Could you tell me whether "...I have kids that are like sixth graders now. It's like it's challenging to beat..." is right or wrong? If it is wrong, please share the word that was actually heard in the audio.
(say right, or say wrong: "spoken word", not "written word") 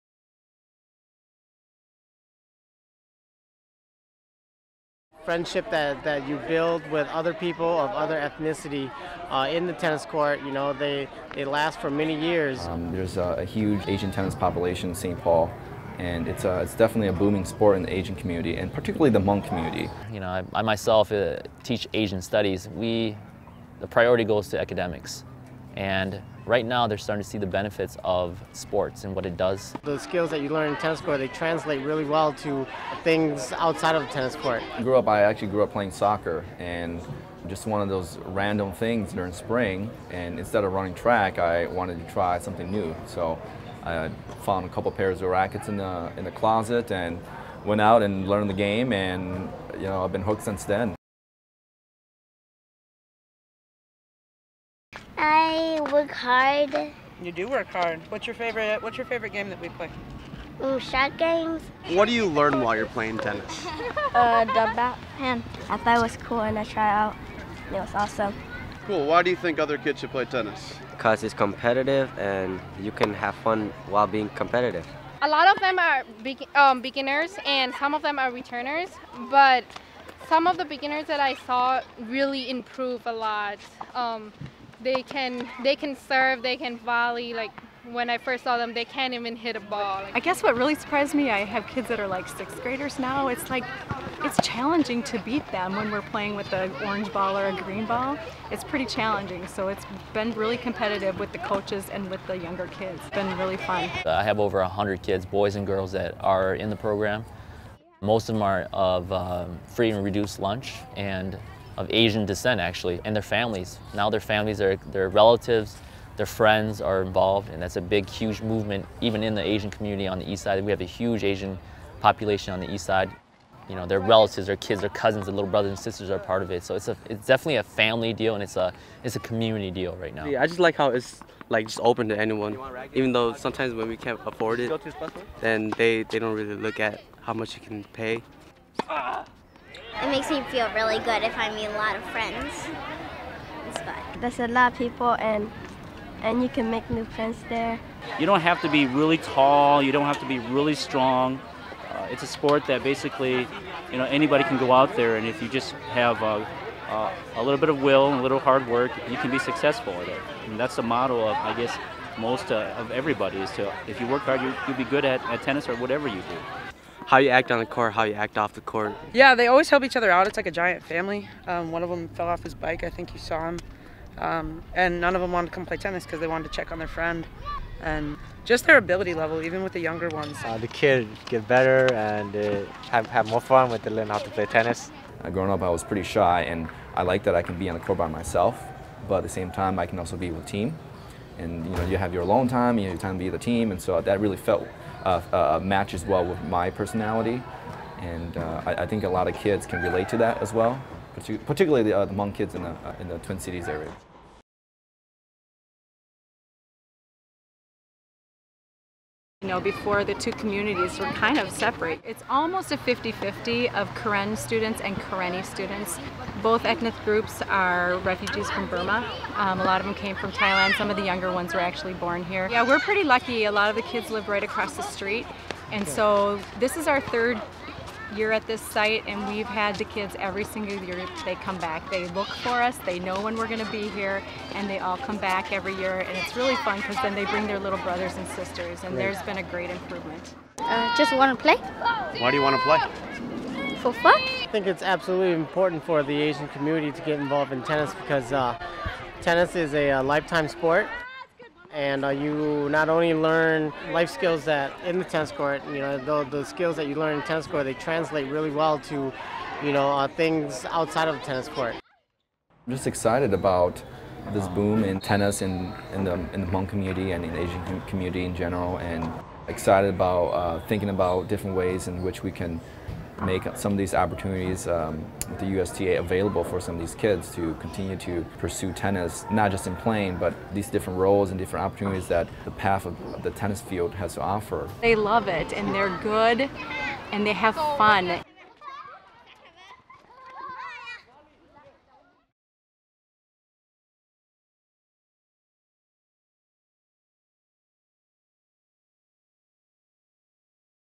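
right.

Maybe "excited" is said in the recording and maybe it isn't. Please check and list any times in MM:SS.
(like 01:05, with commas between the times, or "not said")
04:22, 04:29.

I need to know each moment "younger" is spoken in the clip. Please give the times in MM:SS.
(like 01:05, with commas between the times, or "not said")
01:42, 02:59, 03:41.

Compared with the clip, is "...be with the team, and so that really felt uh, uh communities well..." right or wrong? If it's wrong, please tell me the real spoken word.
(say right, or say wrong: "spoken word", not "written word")
wrong: "matches", not "communities".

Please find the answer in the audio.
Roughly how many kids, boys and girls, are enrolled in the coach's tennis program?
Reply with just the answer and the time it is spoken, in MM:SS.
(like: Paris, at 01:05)
Over 100, at 01:44.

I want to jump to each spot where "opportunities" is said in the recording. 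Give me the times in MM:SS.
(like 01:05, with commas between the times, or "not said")
04:33, 04:41.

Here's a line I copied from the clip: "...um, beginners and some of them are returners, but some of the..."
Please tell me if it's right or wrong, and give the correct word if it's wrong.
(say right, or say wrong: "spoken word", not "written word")
right.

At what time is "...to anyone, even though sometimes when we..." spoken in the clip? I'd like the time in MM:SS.
02:12.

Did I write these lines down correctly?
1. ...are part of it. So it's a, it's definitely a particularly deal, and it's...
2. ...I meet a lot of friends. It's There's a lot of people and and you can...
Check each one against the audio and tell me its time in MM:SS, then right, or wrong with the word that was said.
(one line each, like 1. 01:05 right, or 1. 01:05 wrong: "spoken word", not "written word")
1. 02:06 wrong: "family", not "particularly"
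2. 02:21 right.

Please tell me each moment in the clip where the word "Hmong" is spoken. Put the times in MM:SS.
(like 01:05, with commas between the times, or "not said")
00:19, 04:26.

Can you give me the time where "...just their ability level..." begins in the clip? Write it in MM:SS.
02:58.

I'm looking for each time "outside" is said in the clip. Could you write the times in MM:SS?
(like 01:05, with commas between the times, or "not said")
00:33, 04:20.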